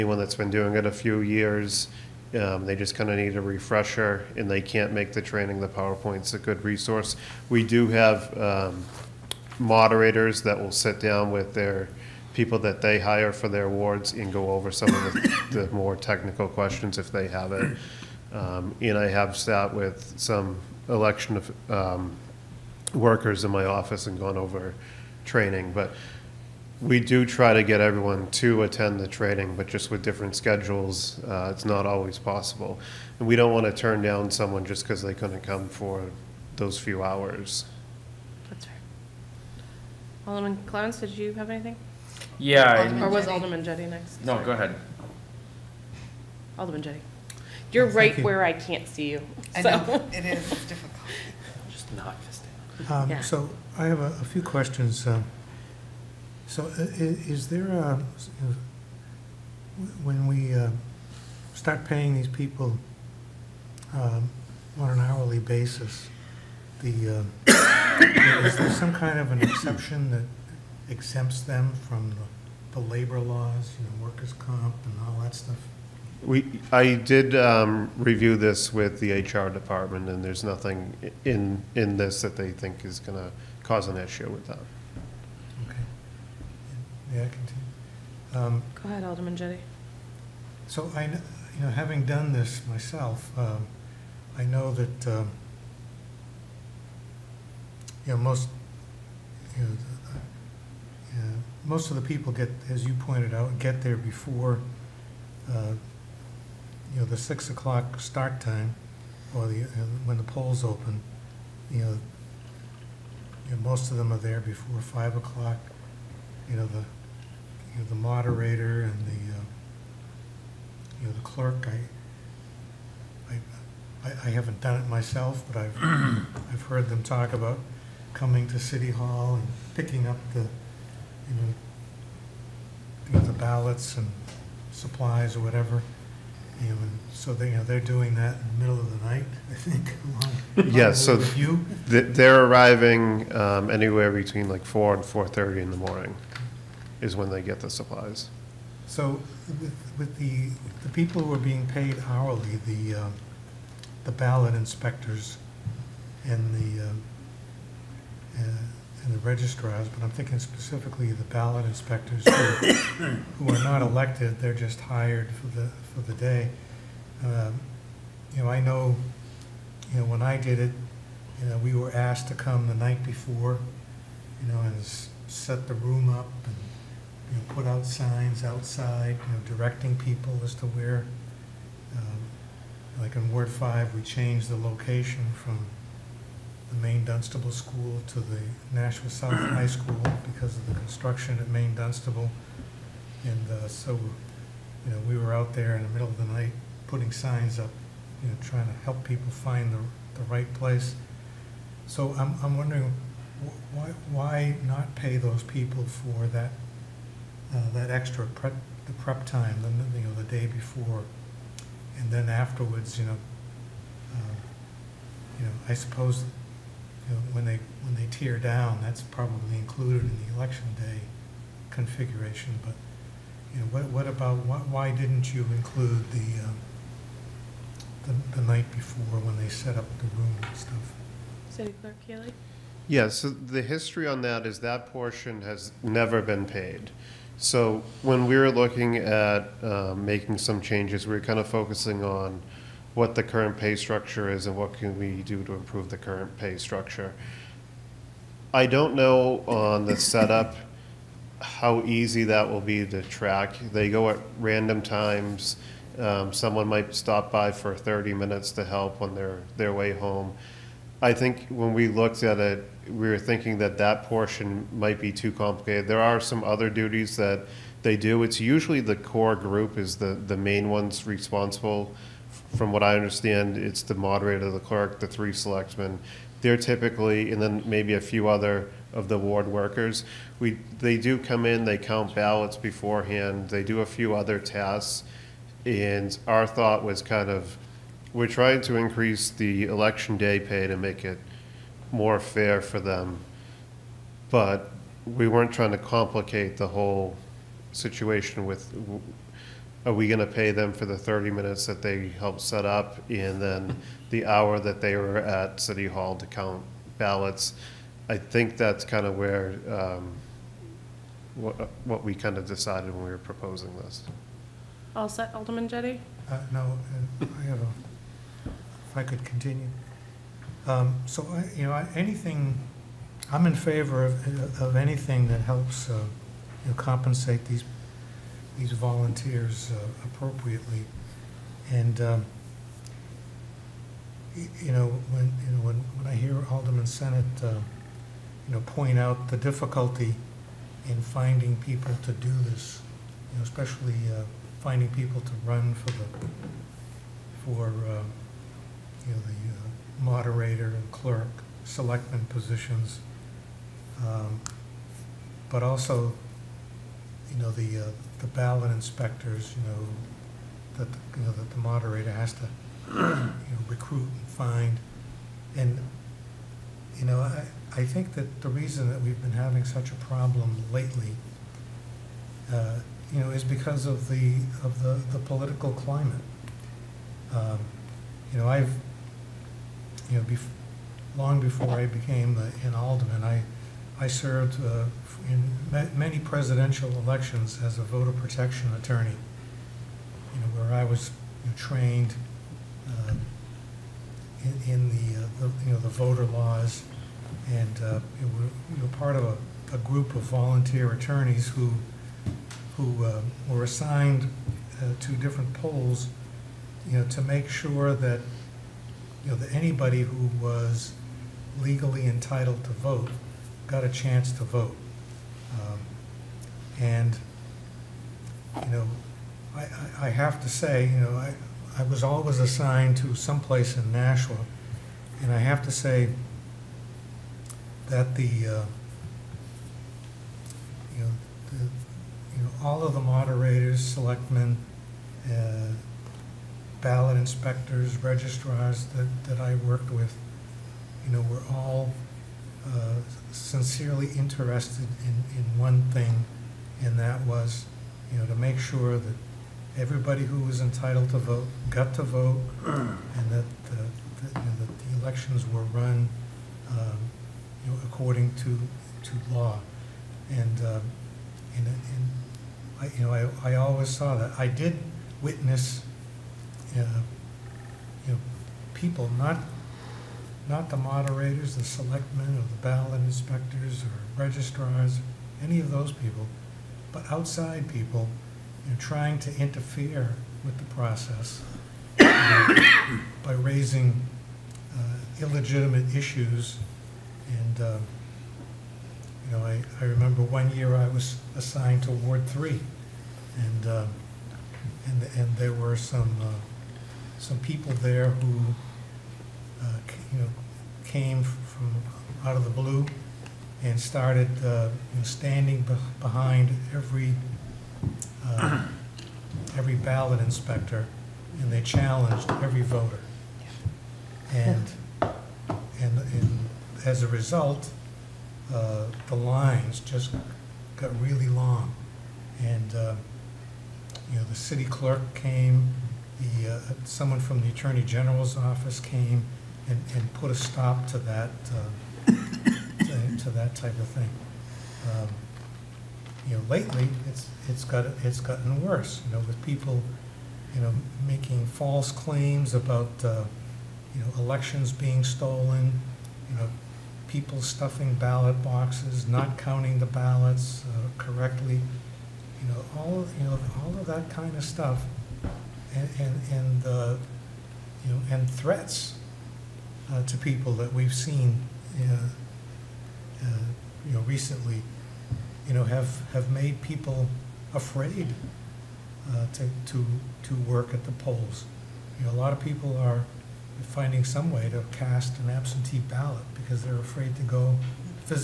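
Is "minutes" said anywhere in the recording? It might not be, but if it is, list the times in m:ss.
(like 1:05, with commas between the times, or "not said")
4:18, 5:01.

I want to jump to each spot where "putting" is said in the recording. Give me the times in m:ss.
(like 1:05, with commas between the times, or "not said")
3:16.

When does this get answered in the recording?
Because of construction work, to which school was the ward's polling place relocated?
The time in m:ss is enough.
3:08.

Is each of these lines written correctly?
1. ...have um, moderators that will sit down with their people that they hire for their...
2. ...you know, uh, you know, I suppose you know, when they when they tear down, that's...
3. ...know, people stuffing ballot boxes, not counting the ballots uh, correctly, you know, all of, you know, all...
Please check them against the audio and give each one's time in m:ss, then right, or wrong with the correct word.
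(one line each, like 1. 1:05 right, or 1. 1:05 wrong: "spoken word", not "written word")
1. 0:07 right
2. 3:32 right
3. 9:06 right.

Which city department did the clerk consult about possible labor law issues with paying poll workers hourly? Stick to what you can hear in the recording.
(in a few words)
HR department.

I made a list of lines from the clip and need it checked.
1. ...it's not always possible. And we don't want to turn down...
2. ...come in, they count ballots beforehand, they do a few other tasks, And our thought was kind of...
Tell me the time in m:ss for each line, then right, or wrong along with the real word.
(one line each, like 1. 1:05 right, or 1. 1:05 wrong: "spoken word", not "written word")
1. 0:31 right
2. 4:41 right.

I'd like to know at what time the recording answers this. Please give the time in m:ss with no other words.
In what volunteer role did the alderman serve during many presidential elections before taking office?
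6:27.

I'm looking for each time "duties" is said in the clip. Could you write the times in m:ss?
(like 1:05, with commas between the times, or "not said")
4:26.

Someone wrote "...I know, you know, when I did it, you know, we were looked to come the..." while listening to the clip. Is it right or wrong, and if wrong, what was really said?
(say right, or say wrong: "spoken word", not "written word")
wrong: "asked", not "looked".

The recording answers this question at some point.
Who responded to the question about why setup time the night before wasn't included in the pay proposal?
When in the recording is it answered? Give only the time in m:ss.
3:51.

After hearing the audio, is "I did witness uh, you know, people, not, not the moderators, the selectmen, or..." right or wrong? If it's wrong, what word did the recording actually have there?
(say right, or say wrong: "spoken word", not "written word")
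right.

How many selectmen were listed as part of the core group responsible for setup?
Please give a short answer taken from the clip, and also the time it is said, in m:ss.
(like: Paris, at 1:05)
3, at 4:35.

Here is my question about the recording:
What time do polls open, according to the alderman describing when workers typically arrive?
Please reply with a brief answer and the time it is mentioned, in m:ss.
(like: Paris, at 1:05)
6:00, at 1:47.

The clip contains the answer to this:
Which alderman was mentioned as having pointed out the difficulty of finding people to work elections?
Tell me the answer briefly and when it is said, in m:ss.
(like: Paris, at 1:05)
Alderman Sennott, at 5:36.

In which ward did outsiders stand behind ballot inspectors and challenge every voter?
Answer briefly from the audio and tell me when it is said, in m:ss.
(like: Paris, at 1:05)
Ward 3, at 8:11.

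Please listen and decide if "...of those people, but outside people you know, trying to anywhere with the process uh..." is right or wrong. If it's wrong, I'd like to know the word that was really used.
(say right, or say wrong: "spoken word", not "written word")
wrong: "interfere", not "anywhere".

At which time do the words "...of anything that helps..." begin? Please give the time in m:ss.
5:24.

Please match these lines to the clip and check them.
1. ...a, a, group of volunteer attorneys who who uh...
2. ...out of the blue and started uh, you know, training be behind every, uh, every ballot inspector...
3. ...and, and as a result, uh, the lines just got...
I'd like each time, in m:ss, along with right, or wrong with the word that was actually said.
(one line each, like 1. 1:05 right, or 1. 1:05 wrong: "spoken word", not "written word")
1. 6:39 right
2. 8:22 wrong: "standing", not "training"
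3. 8:35 right.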